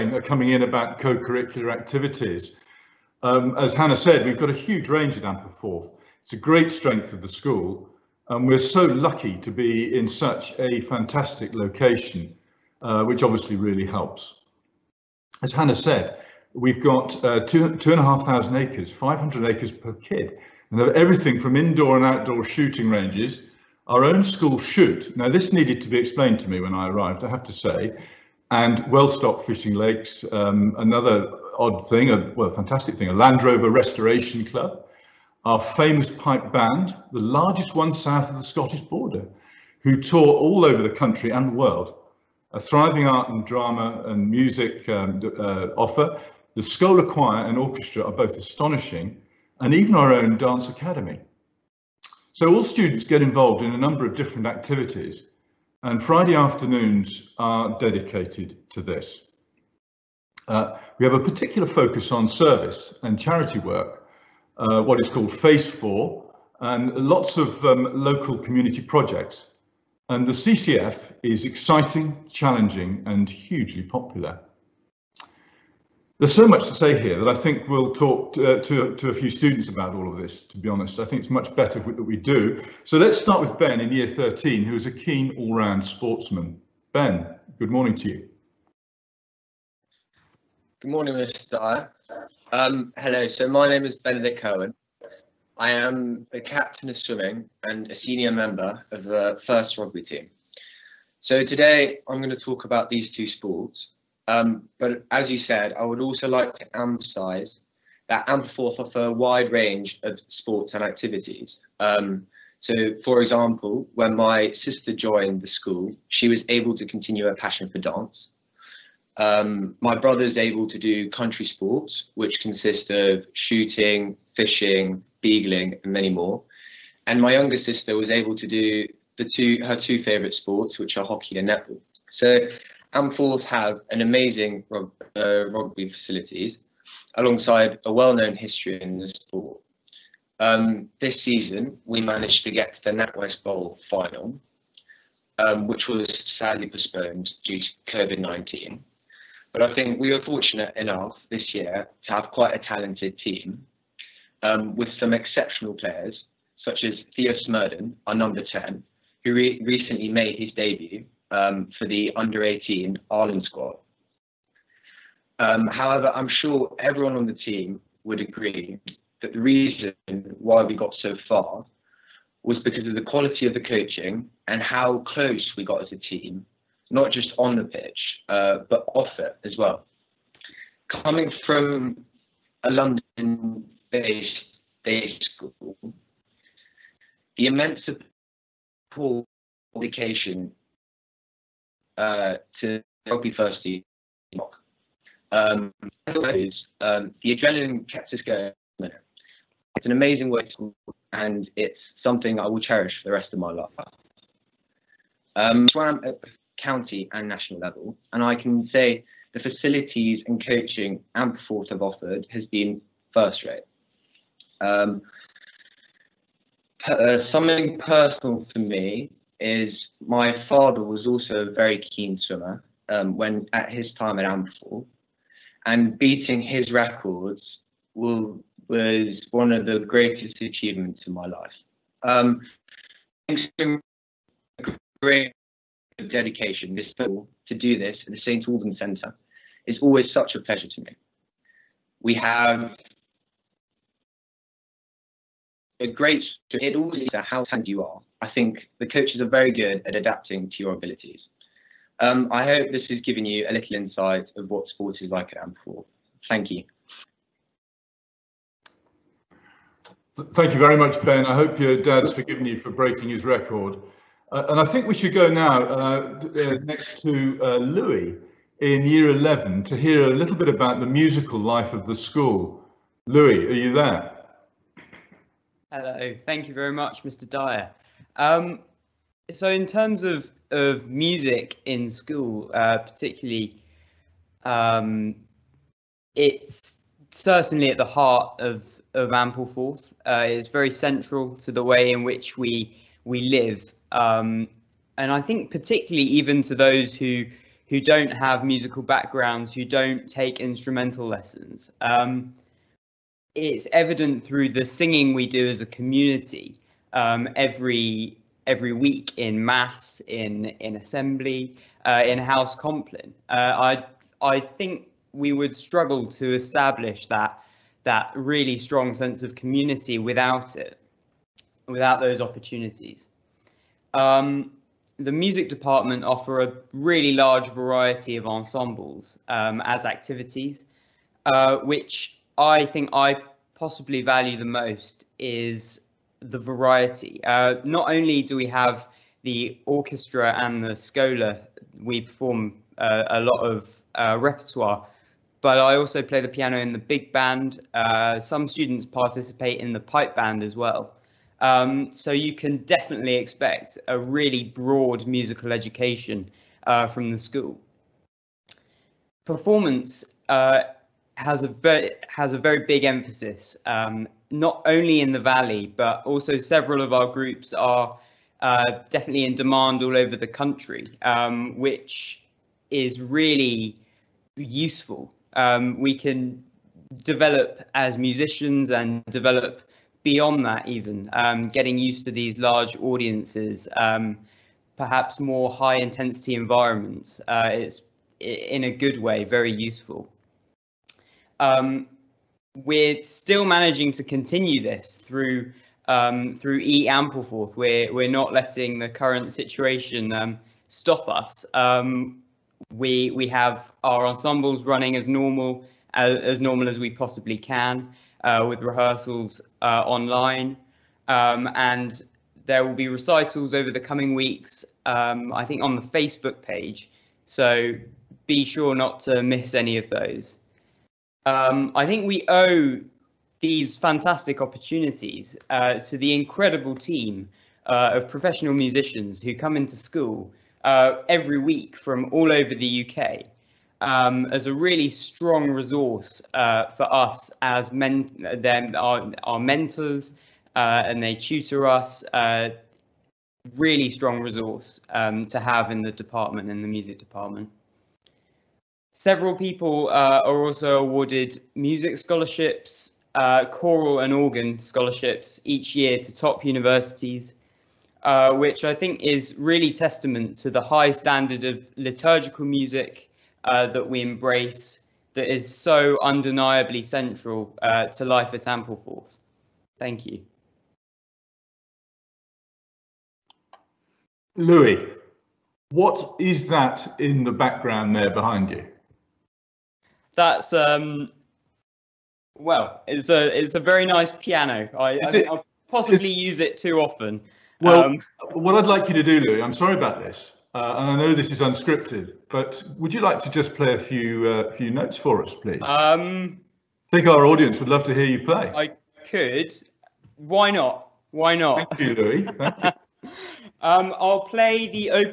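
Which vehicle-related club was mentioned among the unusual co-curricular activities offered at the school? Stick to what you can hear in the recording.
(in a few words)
Land Rover Restoration Club.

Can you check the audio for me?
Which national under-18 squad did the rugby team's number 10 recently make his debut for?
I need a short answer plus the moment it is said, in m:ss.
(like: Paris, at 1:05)
Ireland, at 2:42.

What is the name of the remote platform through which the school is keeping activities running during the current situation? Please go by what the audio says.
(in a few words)
E Ampleforth.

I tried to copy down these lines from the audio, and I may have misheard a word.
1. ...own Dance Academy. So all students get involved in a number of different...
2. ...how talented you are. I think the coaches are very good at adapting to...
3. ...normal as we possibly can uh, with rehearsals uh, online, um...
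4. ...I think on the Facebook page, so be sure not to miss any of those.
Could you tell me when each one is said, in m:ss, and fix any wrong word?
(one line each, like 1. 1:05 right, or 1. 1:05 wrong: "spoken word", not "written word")
1. 0:50 right
2. 4:07 right
3. 6:46 right
4. 6:55 right.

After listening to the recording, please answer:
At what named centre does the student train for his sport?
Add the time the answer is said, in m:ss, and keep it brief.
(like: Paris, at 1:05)
St. Albans Centre, at 3:58.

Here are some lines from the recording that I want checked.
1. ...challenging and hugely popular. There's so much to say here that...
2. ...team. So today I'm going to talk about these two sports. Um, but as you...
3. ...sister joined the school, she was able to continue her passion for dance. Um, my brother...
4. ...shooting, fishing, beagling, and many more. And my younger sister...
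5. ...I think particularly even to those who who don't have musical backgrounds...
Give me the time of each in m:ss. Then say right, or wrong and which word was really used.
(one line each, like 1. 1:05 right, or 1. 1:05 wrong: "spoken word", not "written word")
1. 1:12 right
2. 1:40 right
3. 1:54 right
4. 2:03 right
5. 4:55 right.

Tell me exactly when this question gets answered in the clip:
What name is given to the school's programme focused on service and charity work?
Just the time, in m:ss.
1:05.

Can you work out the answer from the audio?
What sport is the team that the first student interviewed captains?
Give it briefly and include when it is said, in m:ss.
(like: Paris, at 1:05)
Swimming, at 1:36.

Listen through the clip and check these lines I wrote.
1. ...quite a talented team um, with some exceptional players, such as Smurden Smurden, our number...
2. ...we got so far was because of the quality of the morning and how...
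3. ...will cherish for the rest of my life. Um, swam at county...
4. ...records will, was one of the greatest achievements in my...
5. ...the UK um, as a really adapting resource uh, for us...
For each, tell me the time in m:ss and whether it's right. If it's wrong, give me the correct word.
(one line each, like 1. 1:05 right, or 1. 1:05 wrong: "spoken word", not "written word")
1. 2:32 wrong: "Theo", not "Smurden"
2. 2:50 wrong: "coaching", not "morning"
3. 3:22 right
4. 3:46 right
5. 7:12 wrong: "strong", not "adapting".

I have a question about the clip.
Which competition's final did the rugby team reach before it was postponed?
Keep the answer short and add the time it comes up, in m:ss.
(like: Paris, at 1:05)
NatWest Bowl, at 2:22.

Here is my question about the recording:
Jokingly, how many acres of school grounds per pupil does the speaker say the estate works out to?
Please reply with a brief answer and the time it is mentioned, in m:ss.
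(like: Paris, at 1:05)
500, at 0:18.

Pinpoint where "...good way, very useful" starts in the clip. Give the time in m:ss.
6:28.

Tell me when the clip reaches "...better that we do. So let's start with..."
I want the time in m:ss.
1:21.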